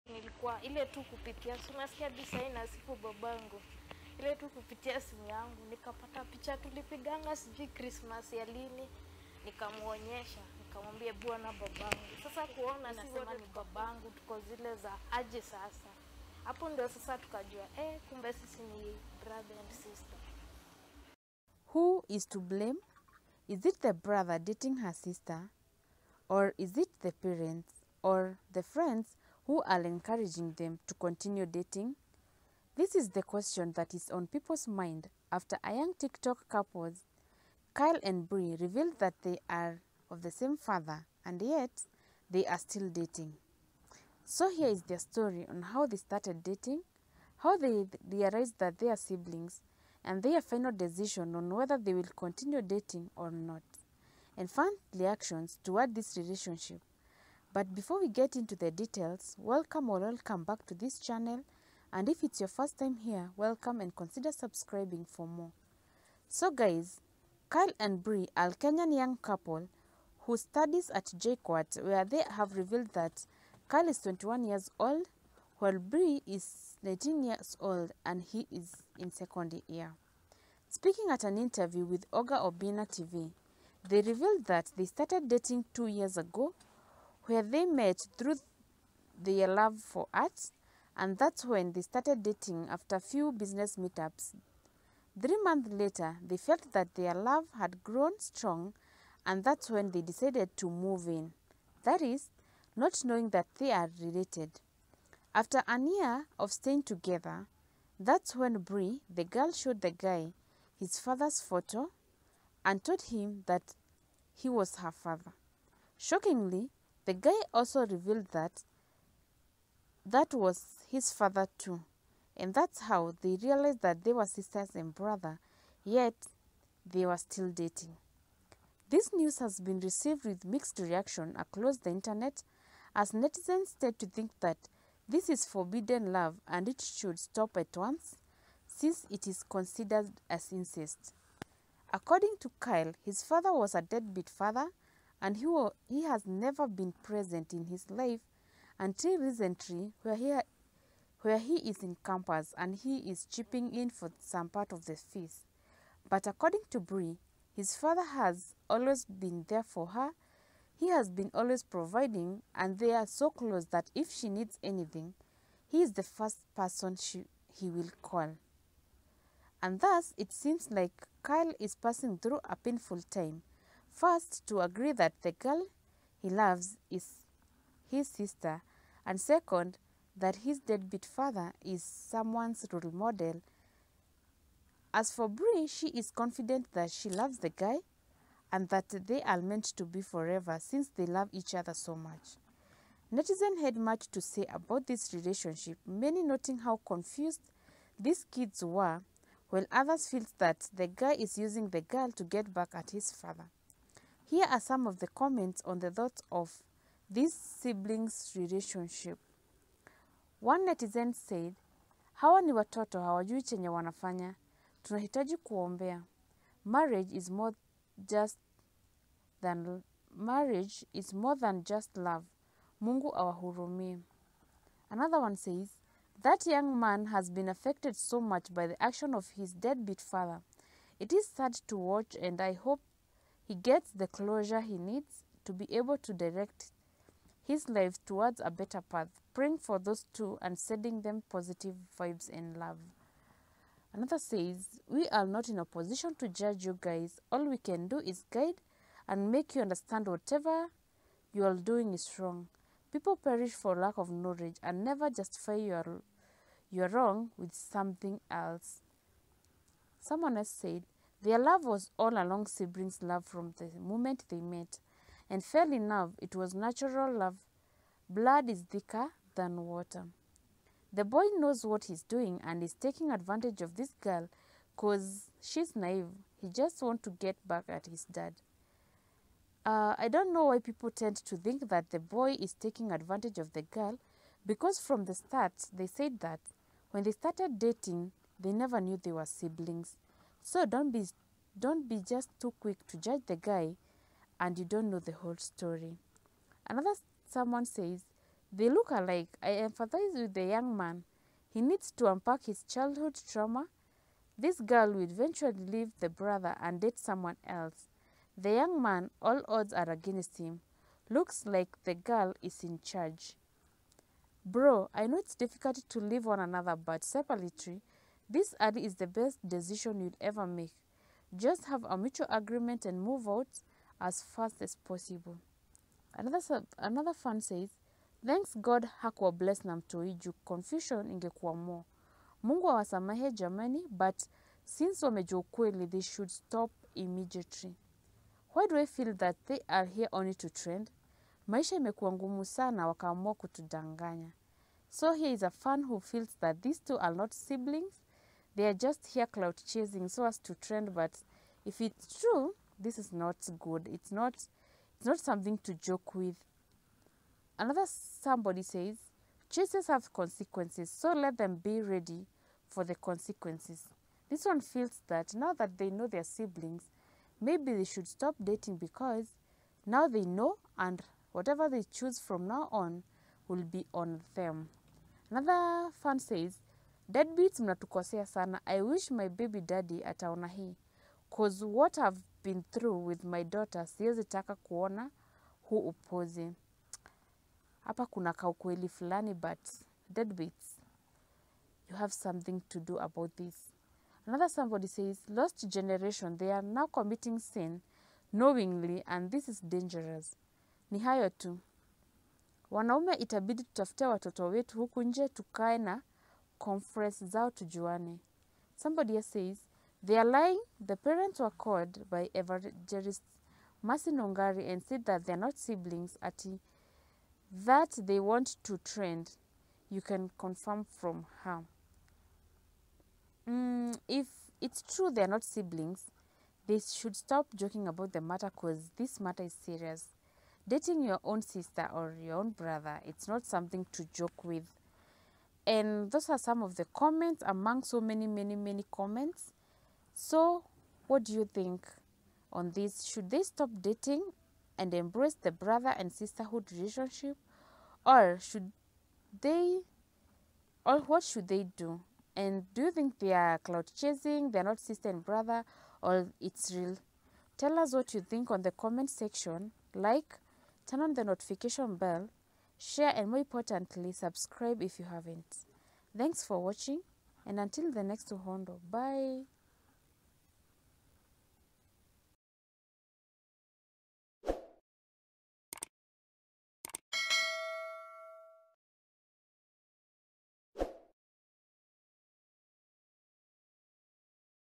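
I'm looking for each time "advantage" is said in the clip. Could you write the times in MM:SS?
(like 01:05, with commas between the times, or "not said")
04:33, 04:42.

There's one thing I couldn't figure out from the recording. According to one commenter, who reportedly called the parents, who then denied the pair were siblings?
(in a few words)
Mercy Nongari.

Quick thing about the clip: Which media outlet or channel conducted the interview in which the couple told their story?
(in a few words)
Oga Obina TV.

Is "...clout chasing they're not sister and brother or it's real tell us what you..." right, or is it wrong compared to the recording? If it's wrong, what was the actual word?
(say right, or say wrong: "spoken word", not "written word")
right.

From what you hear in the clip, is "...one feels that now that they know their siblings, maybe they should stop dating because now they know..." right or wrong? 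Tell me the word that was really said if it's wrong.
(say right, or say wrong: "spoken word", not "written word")
right.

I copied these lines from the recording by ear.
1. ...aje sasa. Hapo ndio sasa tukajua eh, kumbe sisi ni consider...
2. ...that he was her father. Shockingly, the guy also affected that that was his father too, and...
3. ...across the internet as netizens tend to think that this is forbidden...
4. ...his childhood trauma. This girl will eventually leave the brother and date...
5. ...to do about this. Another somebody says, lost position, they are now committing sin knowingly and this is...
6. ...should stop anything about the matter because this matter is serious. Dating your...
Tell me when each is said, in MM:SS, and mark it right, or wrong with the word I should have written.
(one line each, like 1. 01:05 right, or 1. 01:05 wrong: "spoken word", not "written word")
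1. 00:15 wrong: "brother", not "consider"
2. 01:53 wrong: "revealed", not "affected"
3. 02:11 right
4. 05:02 right
5. 06:32 wrong: "generation", not "position"
6. 07:06 wrong: "joking", not "anything".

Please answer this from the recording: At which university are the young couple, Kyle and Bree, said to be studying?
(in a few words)
JKUAT.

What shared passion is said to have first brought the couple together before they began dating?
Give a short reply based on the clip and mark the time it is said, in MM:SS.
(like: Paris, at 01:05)
Art, at 01:30.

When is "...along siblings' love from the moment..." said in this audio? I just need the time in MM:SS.
04:22.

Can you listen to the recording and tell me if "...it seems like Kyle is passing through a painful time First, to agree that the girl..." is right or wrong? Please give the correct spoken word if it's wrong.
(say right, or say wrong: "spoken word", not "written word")
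right.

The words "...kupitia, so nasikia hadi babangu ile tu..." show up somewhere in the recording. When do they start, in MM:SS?
00:01.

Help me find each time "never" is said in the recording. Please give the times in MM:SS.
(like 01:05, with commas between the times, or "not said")
02:26, 04:14, 04:48.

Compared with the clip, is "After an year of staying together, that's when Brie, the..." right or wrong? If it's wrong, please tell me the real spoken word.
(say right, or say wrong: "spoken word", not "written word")
wrong: "Bree", not "Brie".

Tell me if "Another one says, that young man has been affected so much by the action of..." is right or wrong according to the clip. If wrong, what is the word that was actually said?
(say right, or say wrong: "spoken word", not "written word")
right.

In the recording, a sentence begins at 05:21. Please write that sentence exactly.
Just have a mutual agreement and move out as fast as possible.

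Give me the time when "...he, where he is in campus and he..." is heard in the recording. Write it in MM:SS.
02:30.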